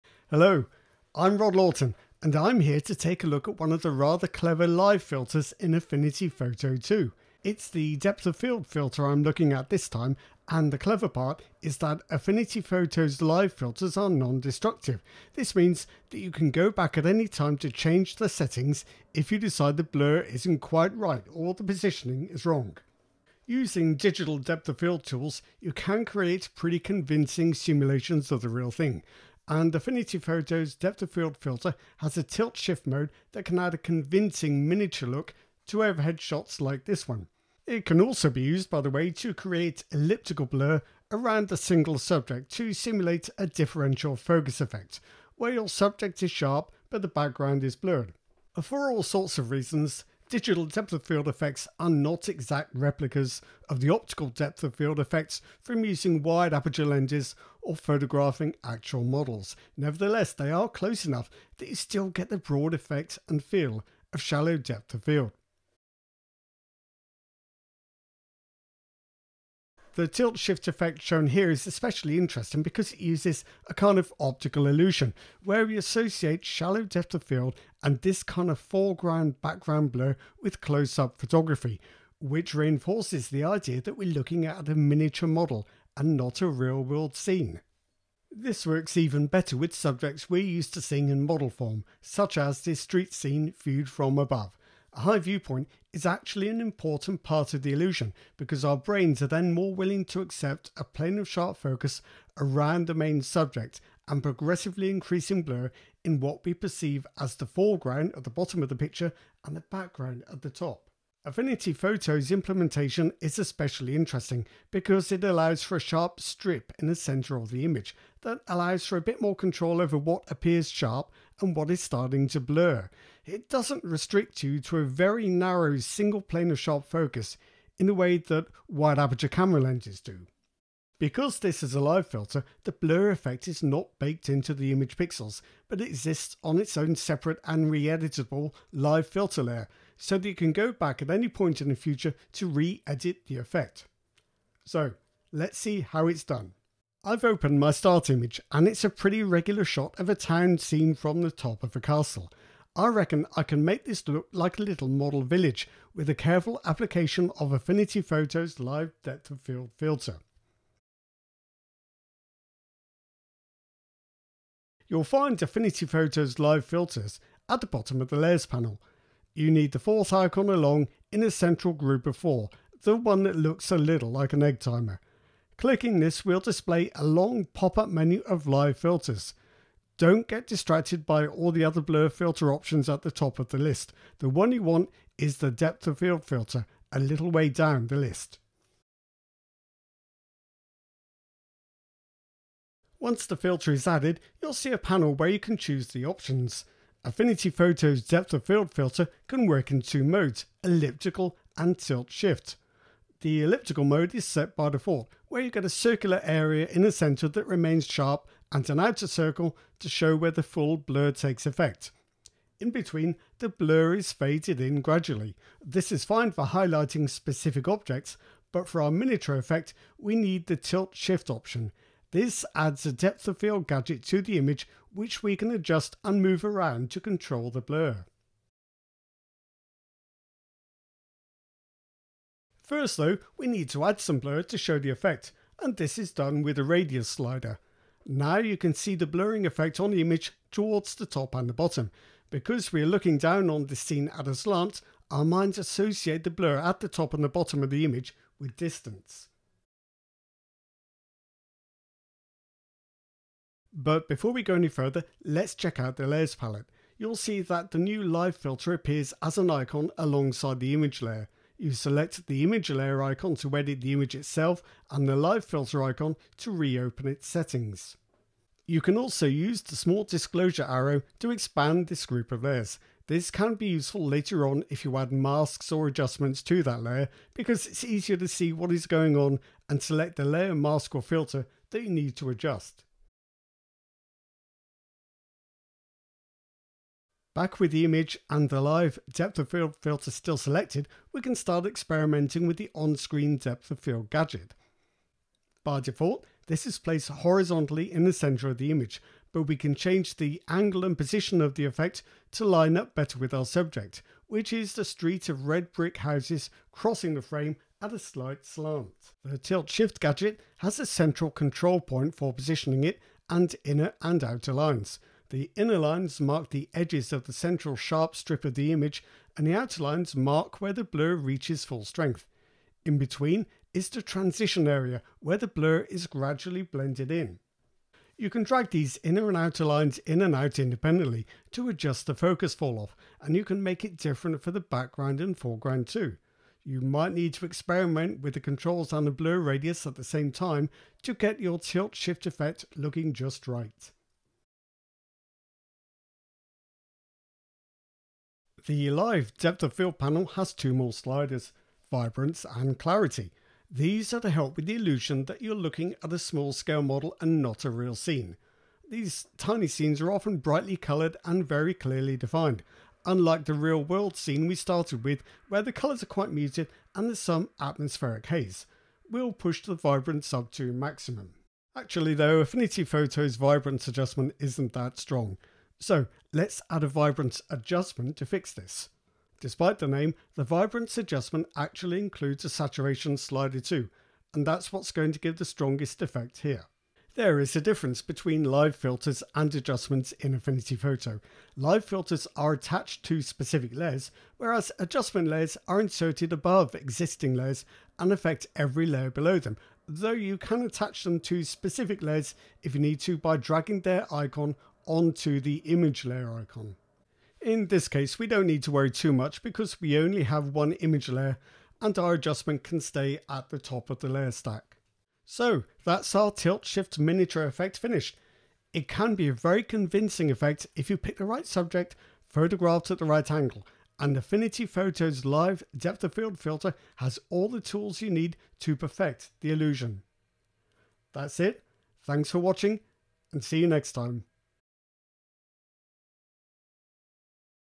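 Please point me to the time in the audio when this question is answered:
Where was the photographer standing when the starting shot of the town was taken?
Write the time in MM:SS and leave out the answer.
02:31.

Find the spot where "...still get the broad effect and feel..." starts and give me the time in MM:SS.
01:01.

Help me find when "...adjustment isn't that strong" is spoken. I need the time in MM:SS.
06:13.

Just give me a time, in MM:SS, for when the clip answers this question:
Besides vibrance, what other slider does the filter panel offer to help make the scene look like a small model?
05:52.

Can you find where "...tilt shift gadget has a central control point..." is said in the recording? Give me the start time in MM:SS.
05:09.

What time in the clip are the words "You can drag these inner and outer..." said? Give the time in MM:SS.
05:28.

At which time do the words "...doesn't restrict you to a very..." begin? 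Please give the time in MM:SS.
02:03.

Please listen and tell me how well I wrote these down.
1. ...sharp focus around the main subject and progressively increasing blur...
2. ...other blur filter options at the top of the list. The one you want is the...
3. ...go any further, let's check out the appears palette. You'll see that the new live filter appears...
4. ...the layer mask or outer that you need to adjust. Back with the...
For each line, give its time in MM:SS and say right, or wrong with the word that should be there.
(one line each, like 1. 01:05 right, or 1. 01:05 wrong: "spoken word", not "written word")
1. 01:41 right
2. 03:01 right
3. 04:14 wrong: "layers", not "appears"
4. 04:40 wrong: "filter", not "outer".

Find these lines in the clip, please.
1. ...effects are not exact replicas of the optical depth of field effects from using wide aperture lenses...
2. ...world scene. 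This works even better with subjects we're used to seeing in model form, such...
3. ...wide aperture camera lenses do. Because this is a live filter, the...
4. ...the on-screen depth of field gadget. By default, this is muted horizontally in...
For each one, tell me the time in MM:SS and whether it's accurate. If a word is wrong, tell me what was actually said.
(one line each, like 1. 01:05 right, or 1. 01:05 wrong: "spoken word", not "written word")
1. 00:51 right
2. 01:26 right
3. 02:08 right
4. 04:52 wrong: "placed", not "muted".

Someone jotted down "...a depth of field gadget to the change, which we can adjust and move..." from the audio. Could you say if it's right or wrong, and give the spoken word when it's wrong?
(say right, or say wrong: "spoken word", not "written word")
wrong: "image", not "change".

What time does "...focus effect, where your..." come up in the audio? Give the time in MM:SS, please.
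00:44.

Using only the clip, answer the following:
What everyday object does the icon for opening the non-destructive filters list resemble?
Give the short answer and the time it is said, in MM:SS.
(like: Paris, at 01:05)
An egg timer, at 02:54.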